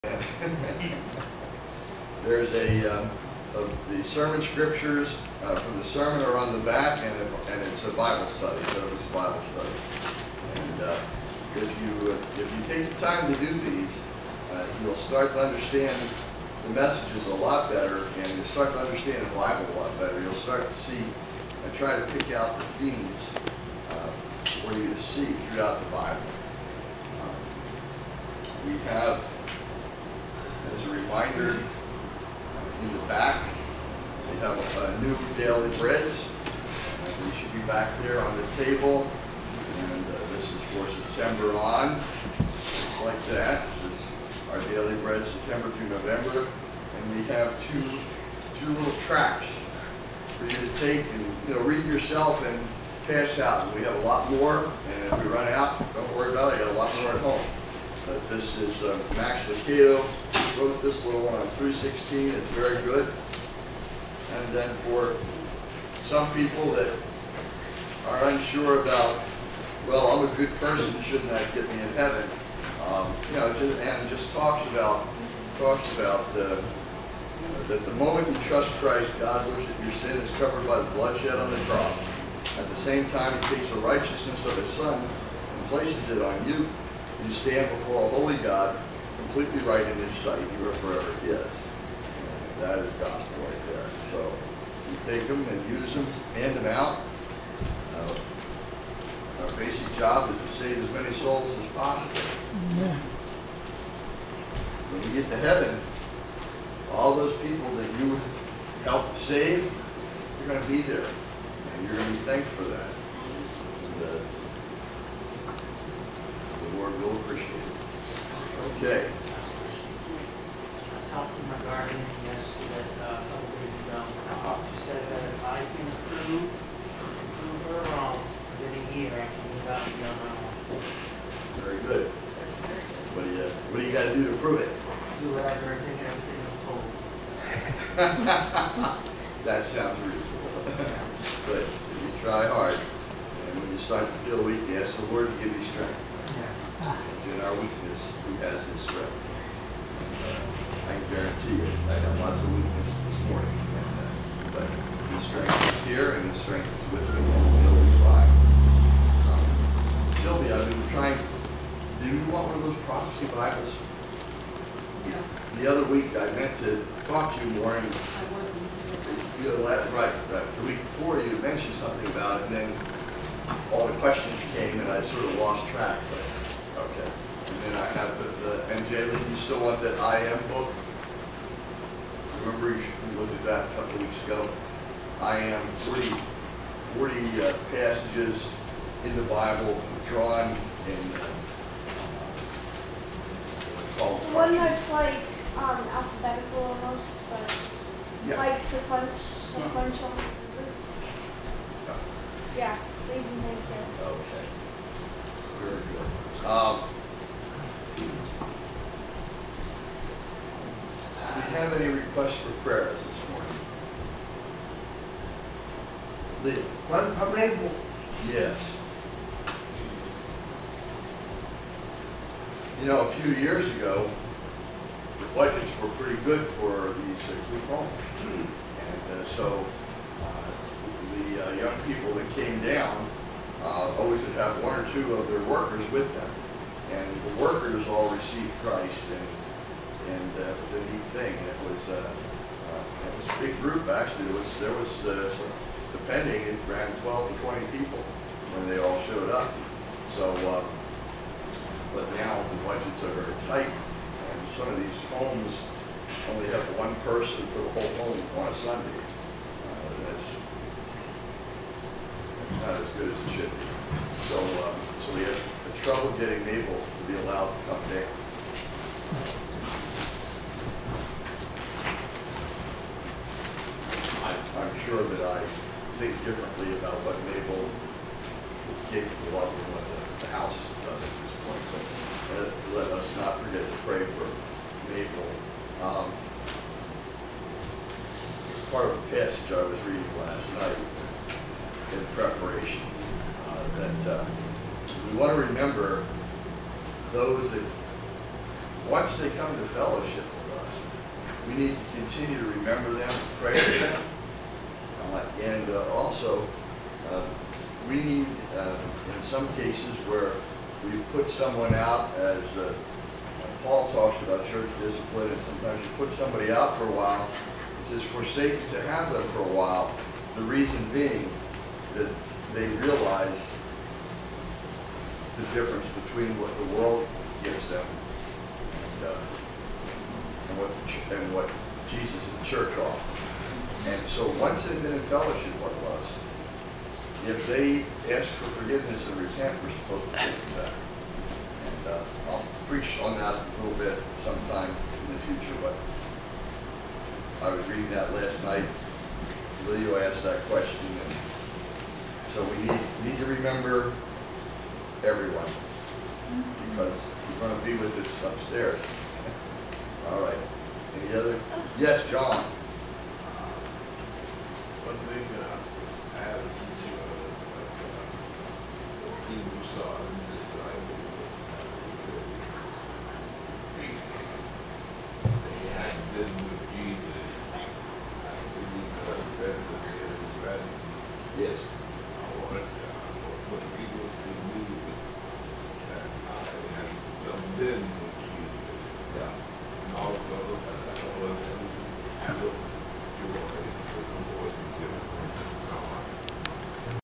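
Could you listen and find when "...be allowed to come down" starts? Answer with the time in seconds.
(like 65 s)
267 s.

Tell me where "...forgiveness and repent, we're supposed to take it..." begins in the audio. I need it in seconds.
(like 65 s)
338 s.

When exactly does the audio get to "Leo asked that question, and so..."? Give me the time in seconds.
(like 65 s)
349 s.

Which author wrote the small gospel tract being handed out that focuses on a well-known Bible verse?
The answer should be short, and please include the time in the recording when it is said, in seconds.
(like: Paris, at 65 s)
Max Lucado, at 59 s.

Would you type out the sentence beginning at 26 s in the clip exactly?
Um, we have as a reminder, uh, in the back, we have a new daily bread.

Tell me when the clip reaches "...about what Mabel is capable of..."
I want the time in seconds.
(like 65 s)
276 s.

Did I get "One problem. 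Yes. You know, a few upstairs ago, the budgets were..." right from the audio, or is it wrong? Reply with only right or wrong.
wrong.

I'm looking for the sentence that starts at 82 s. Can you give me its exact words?
At the same time, He takes the righteousness of His Son and places it on you.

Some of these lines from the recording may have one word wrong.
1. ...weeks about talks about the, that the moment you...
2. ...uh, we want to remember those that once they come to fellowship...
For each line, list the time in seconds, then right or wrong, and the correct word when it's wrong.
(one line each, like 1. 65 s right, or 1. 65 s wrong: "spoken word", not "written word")
1. 74 s wrong: "talks", not "weeks"
2. 294 s right.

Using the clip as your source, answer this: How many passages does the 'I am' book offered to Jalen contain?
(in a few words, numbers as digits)
40.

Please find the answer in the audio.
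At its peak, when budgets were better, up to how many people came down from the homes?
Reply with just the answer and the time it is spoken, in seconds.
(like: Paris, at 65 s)
20, at 247 s.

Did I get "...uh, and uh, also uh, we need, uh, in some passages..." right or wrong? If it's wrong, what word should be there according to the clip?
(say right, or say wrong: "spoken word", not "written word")
wrong: "cases", not "passages".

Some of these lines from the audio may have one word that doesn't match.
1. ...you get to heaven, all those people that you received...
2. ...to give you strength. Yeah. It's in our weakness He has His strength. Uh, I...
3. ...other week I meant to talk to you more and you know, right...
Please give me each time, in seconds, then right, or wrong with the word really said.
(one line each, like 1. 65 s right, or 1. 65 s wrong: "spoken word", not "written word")
1. 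105 s wrong: "helped", not "received"
2. 145 s right
3. 165 s right.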